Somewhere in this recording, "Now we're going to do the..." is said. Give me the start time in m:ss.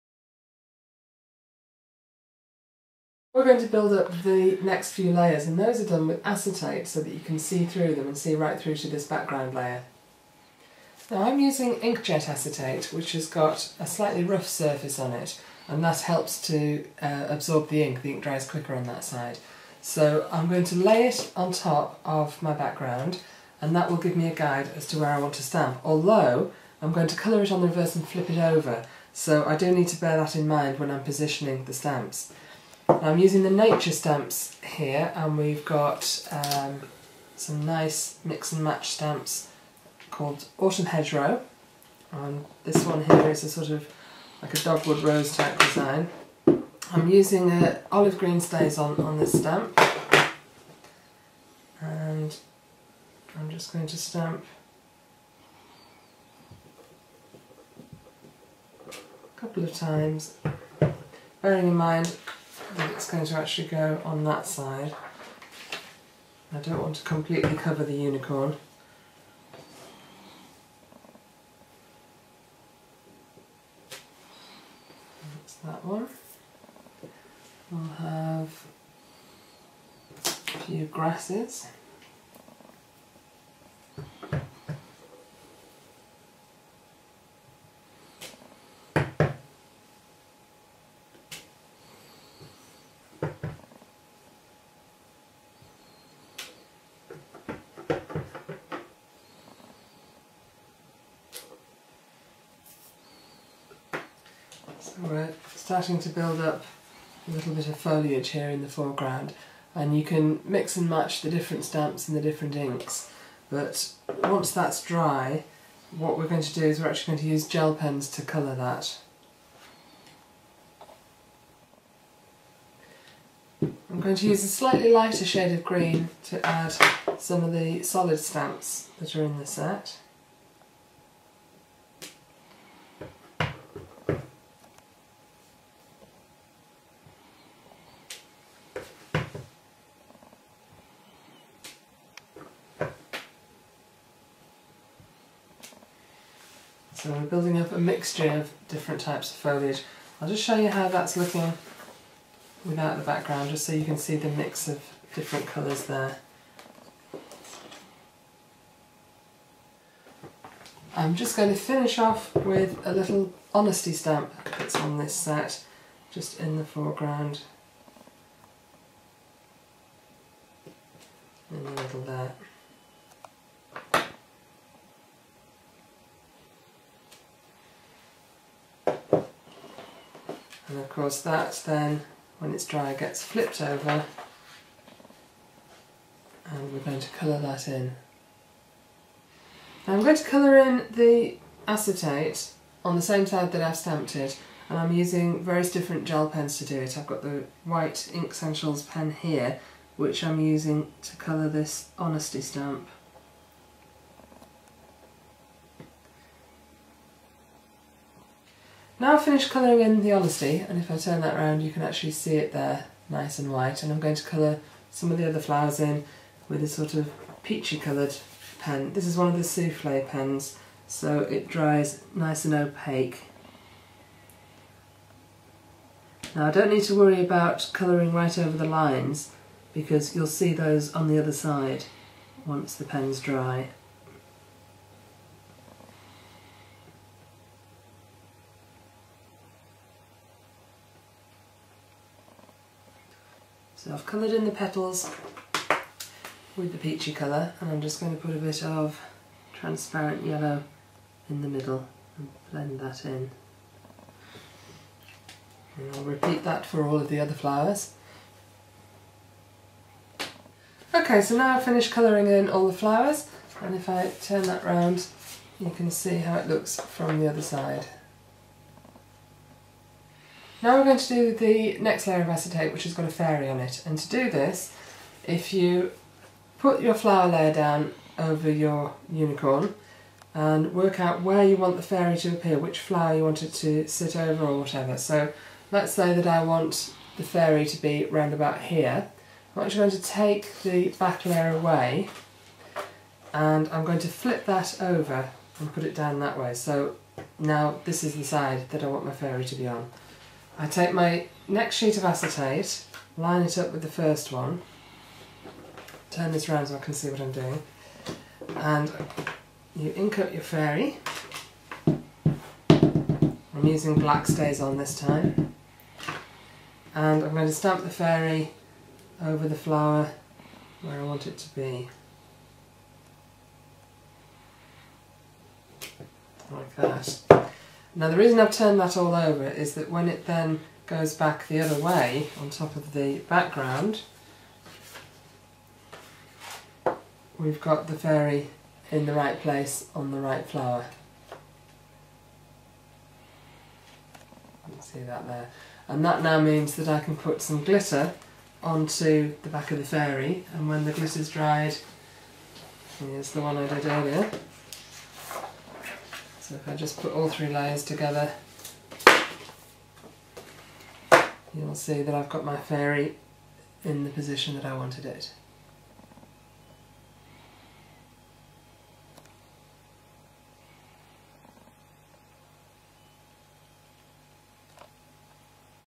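4:30.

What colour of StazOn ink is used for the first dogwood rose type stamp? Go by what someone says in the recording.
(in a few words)
Olive green.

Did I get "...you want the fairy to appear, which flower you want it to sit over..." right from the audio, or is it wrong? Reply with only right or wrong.
right.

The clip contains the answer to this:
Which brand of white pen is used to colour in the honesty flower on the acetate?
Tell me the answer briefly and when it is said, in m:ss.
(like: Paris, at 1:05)
Inkssentials, at 3:18.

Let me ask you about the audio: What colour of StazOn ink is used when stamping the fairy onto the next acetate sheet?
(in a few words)
Black.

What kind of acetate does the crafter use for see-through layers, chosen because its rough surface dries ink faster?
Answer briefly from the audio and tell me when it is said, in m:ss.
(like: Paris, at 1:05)
Inkjet acetate, at 0:11.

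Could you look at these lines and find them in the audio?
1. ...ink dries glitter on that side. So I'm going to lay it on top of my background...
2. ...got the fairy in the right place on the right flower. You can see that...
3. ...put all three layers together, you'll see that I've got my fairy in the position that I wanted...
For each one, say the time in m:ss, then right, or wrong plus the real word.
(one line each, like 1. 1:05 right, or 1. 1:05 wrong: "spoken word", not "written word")
1. 0:18 wrong: "quicker", not "glitter"
2. 5:37 right
3. 5:56 right.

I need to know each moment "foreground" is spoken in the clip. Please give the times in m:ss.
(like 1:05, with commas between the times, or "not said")
1:48, 2:46.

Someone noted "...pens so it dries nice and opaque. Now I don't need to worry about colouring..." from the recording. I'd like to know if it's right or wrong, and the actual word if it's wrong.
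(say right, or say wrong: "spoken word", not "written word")
right.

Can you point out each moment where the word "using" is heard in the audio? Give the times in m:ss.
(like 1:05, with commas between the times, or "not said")
0:11, 0:33, 0:47, 3:14, 3:20, 5:13.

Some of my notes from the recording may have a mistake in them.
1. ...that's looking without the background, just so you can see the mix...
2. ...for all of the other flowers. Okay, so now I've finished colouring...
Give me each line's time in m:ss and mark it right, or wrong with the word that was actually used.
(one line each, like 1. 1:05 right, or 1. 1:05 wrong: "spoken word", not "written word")
1. 2:30 right
2. 4:16 right.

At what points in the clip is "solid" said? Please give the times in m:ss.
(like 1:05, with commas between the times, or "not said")
2:07.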